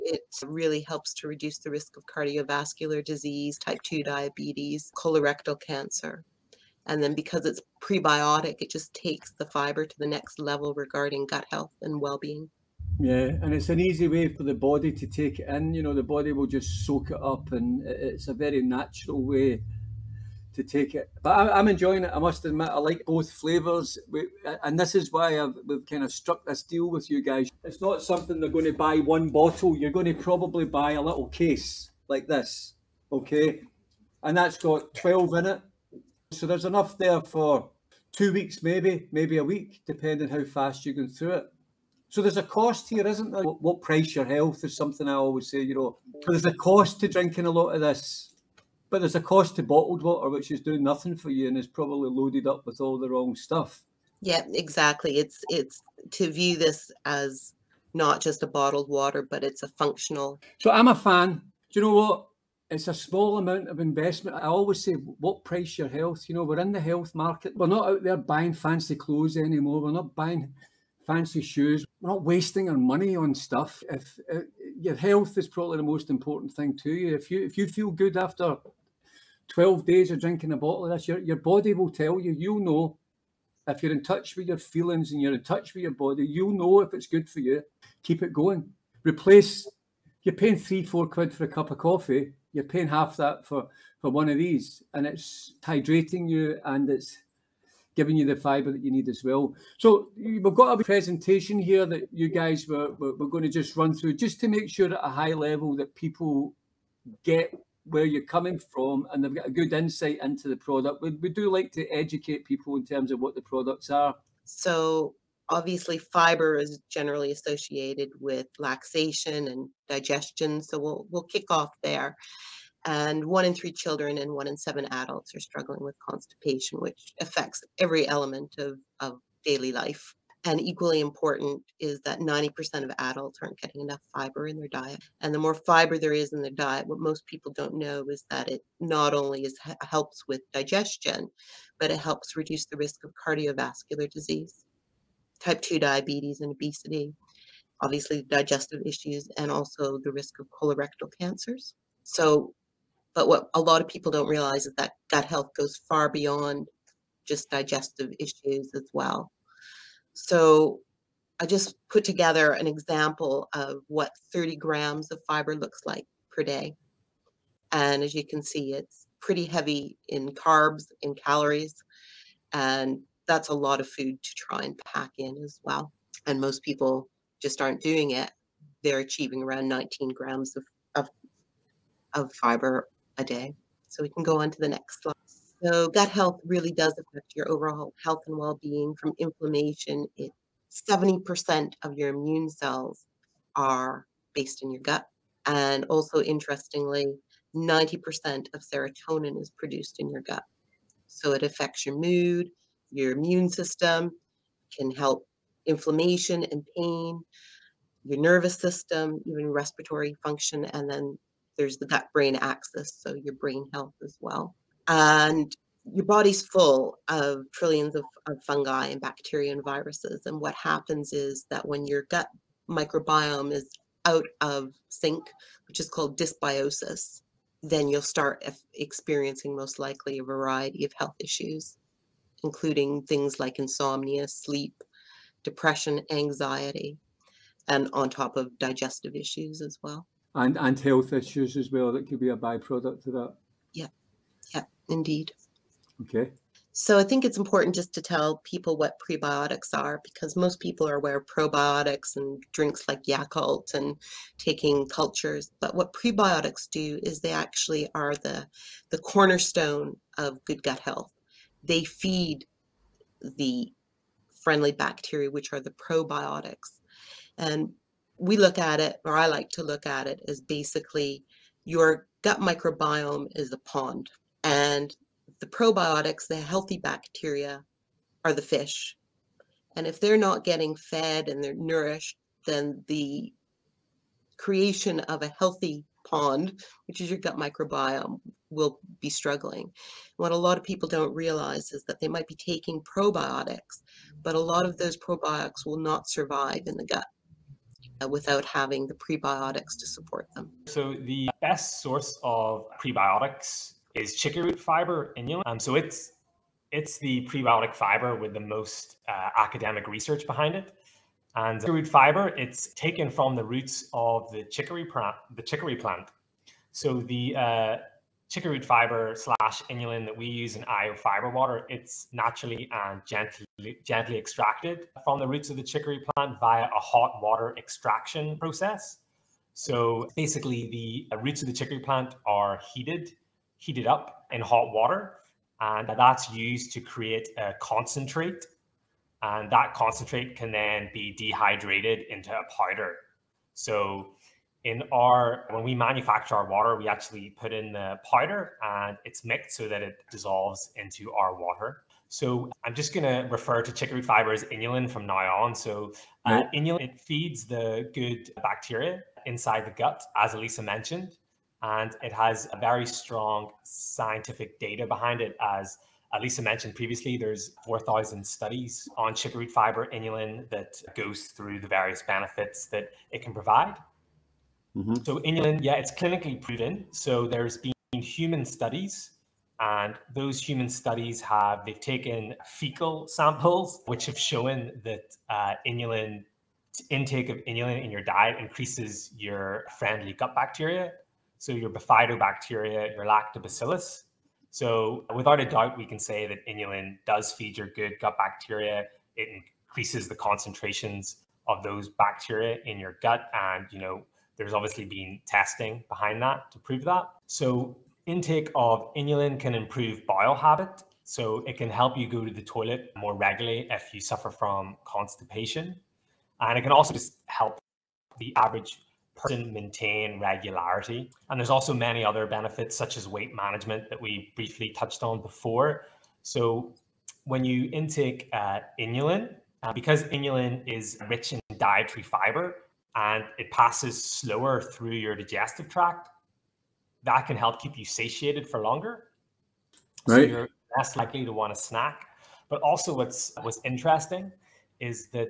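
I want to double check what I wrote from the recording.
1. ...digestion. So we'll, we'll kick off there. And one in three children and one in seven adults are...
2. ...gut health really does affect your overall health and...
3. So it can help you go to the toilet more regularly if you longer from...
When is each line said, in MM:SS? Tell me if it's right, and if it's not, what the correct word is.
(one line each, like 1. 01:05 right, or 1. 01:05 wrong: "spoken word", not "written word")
1. 01:59 right
2. 03:05 right
3. 06:51 wrong: "suffer", not "longer".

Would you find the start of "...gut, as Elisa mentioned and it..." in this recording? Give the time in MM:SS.
05:59.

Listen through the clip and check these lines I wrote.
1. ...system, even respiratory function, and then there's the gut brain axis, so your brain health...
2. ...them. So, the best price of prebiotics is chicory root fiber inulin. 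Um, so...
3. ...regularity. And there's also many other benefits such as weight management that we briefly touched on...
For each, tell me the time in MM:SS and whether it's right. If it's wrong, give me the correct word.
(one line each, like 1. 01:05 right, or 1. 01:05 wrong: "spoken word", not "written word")
1. 03:28 right
2. 05:00 wrong: "source", not "price"
3. 07:00 right.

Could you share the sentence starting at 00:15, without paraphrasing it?
You know, the body will just soak it up, and it's a very natural way to take it.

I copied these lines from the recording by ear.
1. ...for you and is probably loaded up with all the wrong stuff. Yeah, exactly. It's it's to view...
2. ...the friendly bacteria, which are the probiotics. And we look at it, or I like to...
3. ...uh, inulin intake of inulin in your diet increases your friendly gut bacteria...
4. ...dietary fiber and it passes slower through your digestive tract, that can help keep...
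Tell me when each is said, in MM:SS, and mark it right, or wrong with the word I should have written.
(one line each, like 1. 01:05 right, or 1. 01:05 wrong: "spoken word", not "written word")
1. 00:51 right
2. 04:23 right
3. 06:25 right
4. 07:11 right.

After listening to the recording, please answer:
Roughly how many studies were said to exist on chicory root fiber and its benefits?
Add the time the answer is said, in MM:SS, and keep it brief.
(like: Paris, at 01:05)
4,000, at 06:07.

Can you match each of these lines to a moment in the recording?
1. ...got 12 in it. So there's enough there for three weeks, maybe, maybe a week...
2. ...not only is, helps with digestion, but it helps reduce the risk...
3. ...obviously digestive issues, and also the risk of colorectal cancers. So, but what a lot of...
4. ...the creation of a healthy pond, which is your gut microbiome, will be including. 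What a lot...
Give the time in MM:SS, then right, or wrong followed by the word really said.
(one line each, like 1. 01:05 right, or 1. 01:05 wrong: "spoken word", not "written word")
1. 00:34 wrong: "two", not "three"
2. 02:18 right
3. 02:27 right
4. 04:42 wrong: "struggling", not "including".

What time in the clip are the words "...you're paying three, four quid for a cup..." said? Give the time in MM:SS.
01:30.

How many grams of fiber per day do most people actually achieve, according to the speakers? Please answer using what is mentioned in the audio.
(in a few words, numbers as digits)
19 grams.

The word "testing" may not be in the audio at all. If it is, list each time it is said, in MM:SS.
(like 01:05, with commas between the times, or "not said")
06:45.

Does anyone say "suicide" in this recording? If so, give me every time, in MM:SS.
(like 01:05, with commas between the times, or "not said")
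not said.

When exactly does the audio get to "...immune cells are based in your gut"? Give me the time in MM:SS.
03:12.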